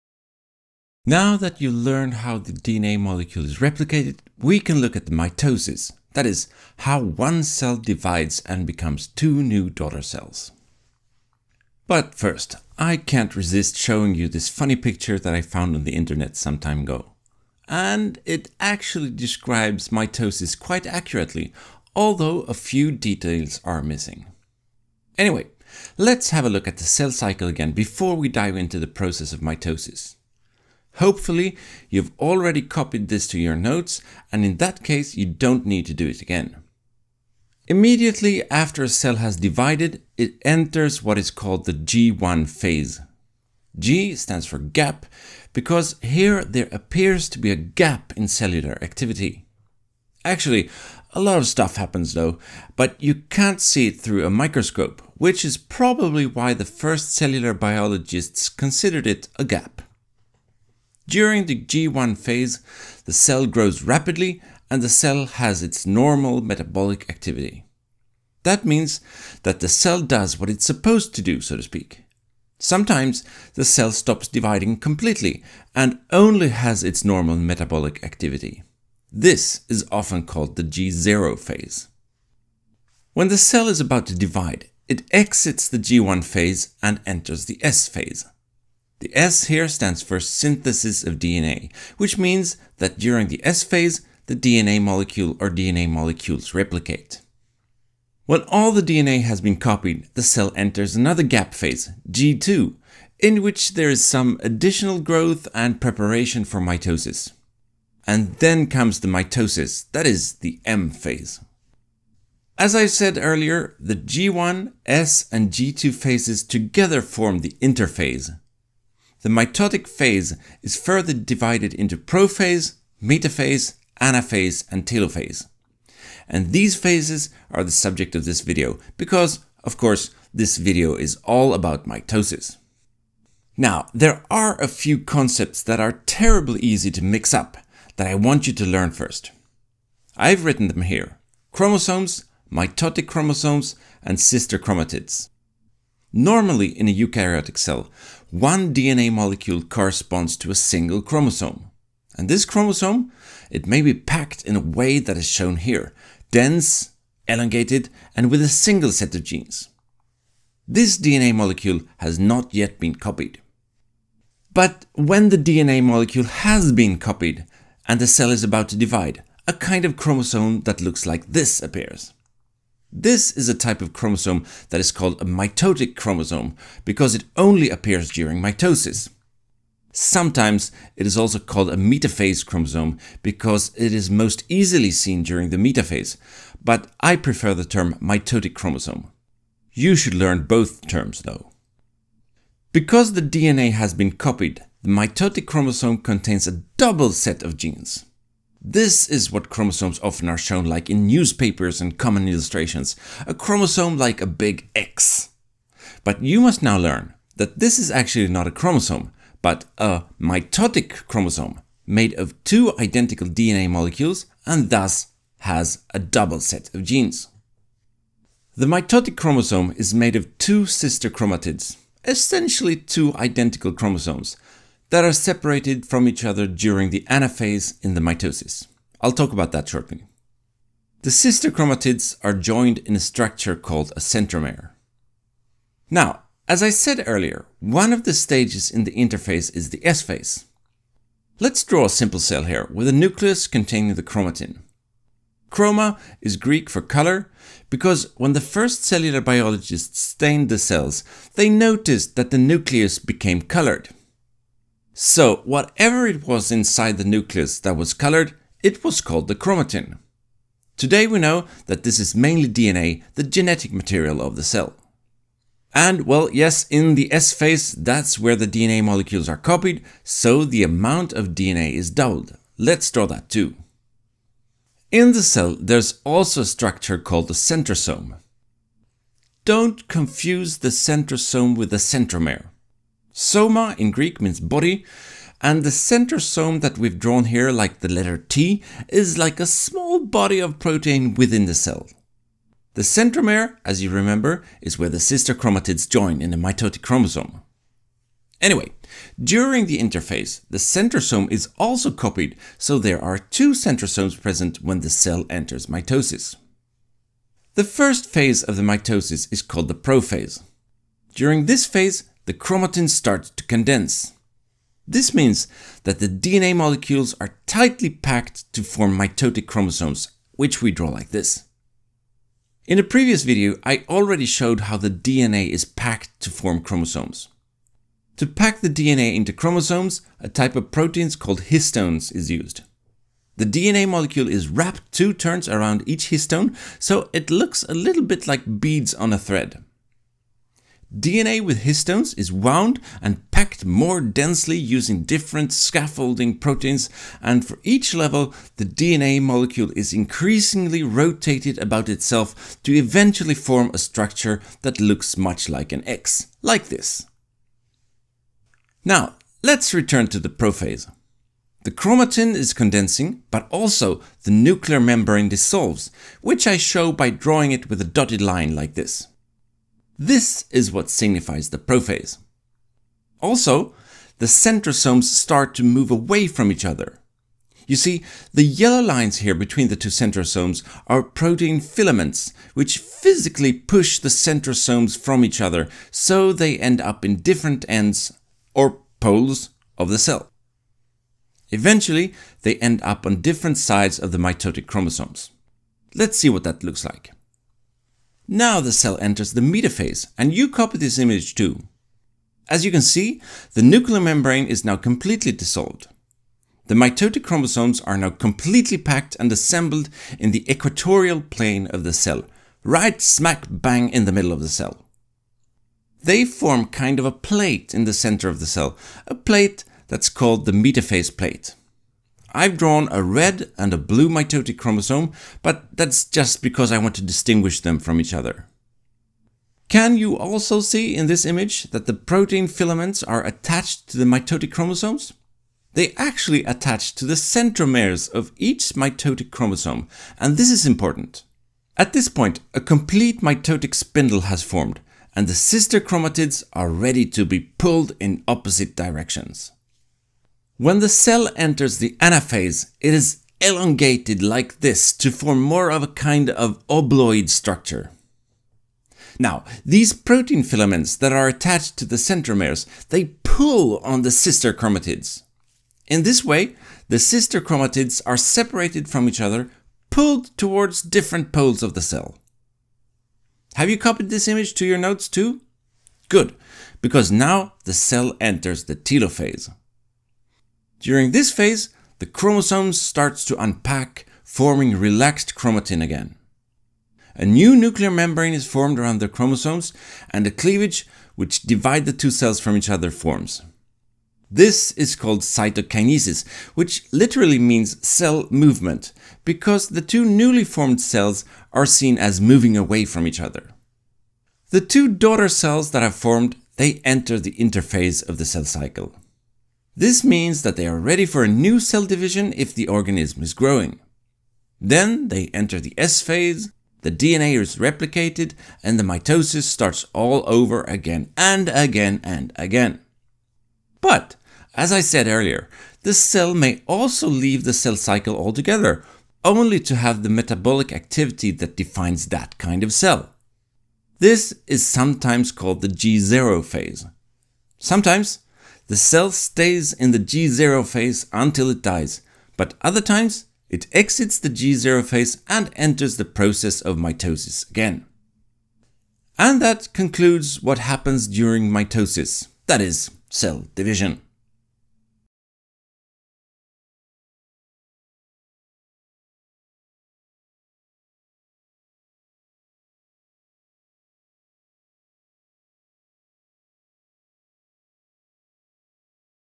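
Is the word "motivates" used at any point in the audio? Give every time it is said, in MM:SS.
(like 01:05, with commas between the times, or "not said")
not said.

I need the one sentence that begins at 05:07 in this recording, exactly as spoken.
The first phase of the mitosis is called the prophase.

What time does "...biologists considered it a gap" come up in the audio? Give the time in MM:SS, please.
00:57.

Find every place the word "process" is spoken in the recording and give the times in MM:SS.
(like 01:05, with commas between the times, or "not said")
00:28, 09:06.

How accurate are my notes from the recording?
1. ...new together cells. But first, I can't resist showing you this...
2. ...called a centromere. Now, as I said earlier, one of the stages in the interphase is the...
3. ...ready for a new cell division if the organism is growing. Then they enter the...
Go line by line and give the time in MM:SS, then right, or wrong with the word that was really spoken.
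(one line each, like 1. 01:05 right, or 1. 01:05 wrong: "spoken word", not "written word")
1. 00:09 wrong: "daughter", not "together"
2. 03:53 right
3. 08:30 right.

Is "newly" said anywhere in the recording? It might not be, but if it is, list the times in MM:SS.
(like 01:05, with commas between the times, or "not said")
08:20.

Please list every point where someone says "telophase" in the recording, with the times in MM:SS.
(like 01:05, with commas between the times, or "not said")
02:04, 07:58.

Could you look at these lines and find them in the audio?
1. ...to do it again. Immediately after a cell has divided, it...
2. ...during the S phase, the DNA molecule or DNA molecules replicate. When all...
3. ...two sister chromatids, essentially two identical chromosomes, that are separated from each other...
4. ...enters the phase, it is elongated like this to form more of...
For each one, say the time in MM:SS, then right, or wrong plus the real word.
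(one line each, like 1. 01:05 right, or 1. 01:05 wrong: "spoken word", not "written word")
1. 00:35 right
2. 01:32 right
3. 03:40 right
4. 07:31 wrong: "anaphase", not "phase".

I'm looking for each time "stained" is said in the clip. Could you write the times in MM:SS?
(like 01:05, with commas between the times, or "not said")
04:10.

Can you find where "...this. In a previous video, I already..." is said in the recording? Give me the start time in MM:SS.
05:21.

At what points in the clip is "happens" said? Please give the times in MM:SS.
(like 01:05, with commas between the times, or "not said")
00:51, 09:10.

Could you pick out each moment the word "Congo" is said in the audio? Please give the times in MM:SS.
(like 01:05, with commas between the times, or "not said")
not said.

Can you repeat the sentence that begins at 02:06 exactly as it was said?
And these phases are the subject of this video because, of course, this video is all about mitosis.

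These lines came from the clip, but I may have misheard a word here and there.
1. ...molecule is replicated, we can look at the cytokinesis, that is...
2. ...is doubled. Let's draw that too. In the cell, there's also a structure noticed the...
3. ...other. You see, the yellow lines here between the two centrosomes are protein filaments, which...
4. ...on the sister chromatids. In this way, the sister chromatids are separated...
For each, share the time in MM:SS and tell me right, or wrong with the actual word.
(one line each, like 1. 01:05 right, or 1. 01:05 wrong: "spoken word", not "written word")
1. 00:02 wrong: "mitosis", not "cytokinesis"
2. 04:31 wrong: "called", not "noticed"
3. 06:16 right
4. 07:43 right.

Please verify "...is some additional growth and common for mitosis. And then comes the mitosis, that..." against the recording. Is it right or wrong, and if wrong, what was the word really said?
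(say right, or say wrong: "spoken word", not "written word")
wrong: "preparation", not "common".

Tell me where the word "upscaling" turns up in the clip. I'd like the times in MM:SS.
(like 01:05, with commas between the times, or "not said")
not said.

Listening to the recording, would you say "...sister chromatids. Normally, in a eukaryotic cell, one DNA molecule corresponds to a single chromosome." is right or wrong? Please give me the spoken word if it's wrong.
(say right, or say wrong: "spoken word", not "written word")
right.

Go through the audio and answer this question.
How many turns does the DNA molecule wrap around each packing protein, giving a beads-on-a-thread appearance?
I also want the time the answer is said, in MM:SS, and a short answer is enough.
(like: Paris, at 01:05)
2, at 05:34.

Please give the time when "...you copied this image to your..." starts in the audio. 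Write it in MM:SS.
07:53.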